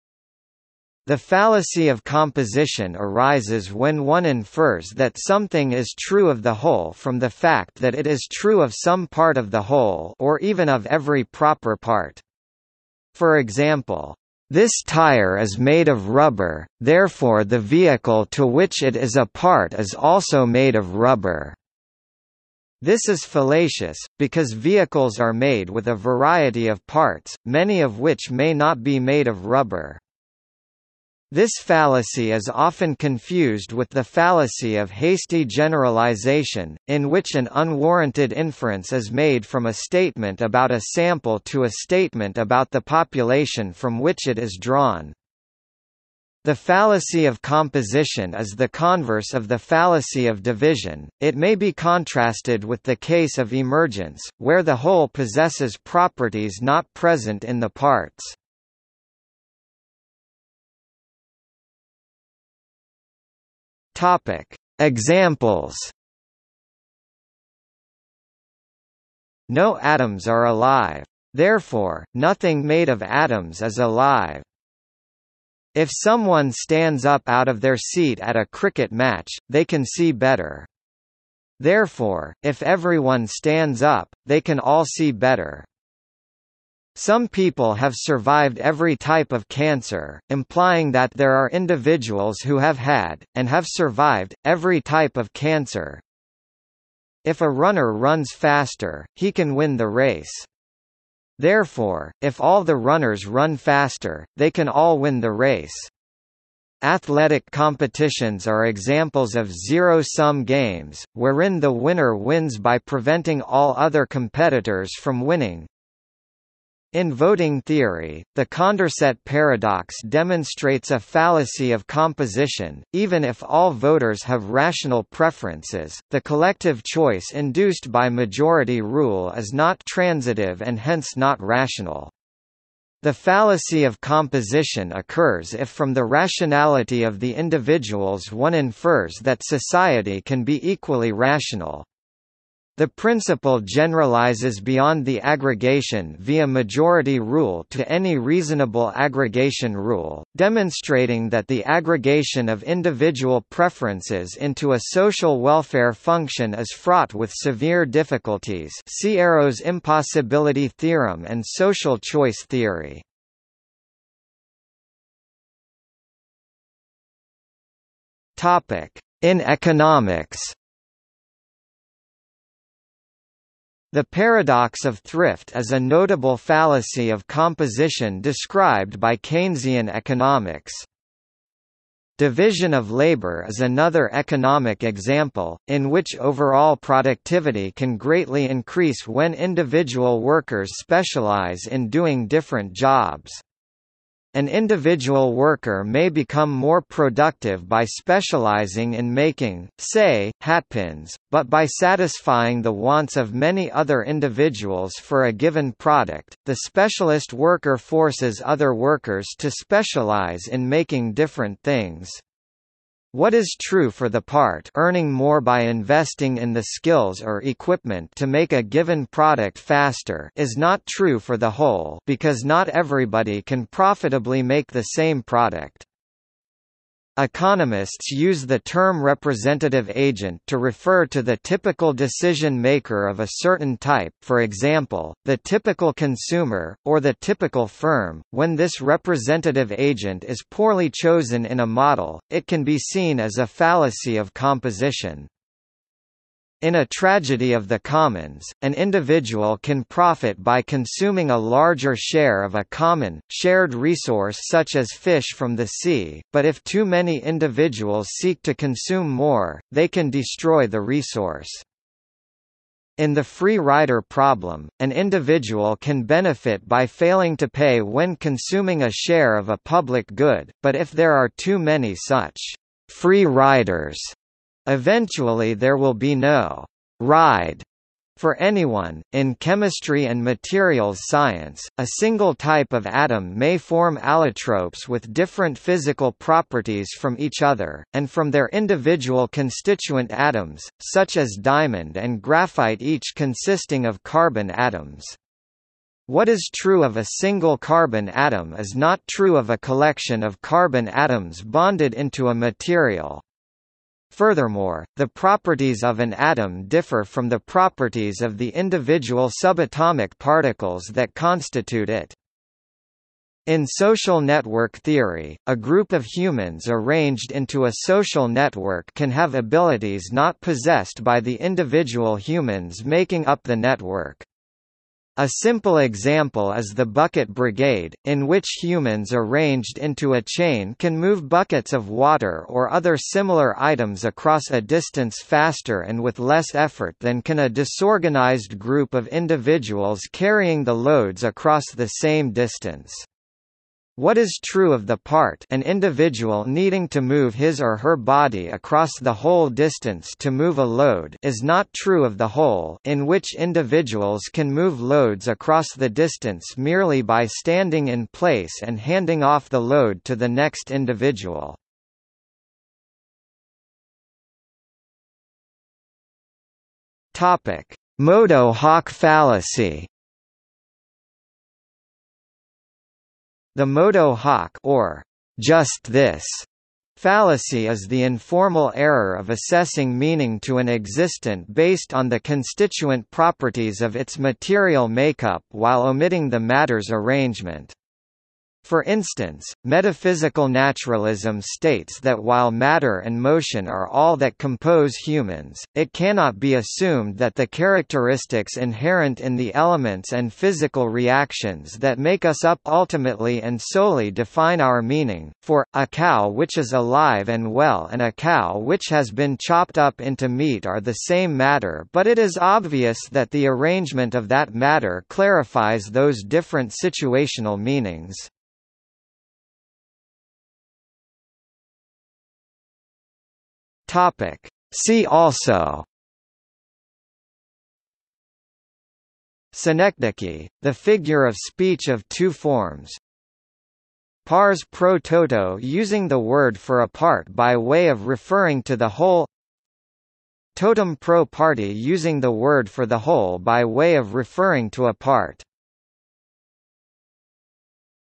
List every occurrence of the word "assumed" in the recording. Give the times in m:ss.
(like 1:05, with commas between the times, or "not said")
6:36.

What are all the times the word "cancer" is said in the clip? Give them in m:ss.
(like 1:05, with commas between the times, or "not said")
1:29, 1:35.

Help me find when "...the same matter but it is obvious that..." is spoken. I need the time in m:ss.
6:50.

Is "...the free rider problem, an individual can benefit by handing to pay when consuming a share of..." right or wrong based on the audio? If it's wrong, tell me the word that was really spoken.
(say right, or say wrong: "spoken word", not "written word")
wrong: "failing", not "handing".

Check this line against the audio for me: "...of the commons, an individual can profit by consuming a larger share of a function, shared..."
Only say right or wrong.
wrong.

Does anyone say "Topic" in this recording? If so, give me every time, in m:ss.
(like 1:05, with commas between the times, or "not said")
1:03, 7:03.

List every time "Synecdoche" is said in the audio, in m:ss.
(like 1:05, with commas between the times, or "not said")
7:09.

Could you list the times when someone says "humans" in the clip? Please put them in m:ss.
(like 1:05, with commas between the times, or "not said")
5:16, 5:22, 5:28, 6:34.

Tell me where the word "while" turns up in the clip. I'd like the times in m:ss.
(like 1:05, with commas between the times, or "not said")
6:25, 6:32.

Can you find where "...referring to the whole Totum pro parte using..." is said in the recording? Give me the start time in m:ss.
7:18.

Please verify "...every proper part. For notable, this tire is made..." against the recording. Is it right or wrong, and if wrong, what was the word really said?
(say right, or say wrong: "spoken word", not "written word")
wrong: "example", not "notable".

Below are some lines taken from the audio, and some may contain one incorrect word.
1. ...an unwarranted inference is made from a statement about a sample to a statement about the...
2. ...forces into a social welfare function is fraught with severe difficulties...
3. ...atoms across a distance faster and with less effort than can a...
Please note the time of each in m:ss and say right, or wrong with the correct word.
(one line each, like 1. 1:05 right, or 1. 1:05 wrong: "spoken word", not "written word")
1. 0:37 right
2. 2:33 wrong: "preferences", not "forces"
3. 5:33 wrong: "items", not "atoms".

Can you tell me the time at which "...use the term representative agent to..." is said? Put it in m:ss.
3:48.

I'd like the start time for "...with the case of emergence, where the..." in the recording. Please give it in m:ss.
0:52.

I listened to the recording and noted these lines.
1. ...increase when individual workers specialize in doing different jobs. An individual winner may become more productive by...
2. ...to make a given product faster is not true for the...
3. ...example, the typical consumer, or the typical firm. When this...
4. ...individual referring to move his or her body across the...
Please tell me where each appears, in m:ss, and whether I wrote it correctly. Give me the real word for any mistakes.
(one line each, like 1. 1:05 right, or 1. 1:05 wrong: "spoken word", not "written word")
1. 3:08 wrong: "worker", not "winner"
2. 3:38 right
3. 3:54 right
4. 5:45 wrong: "needing", not "referring".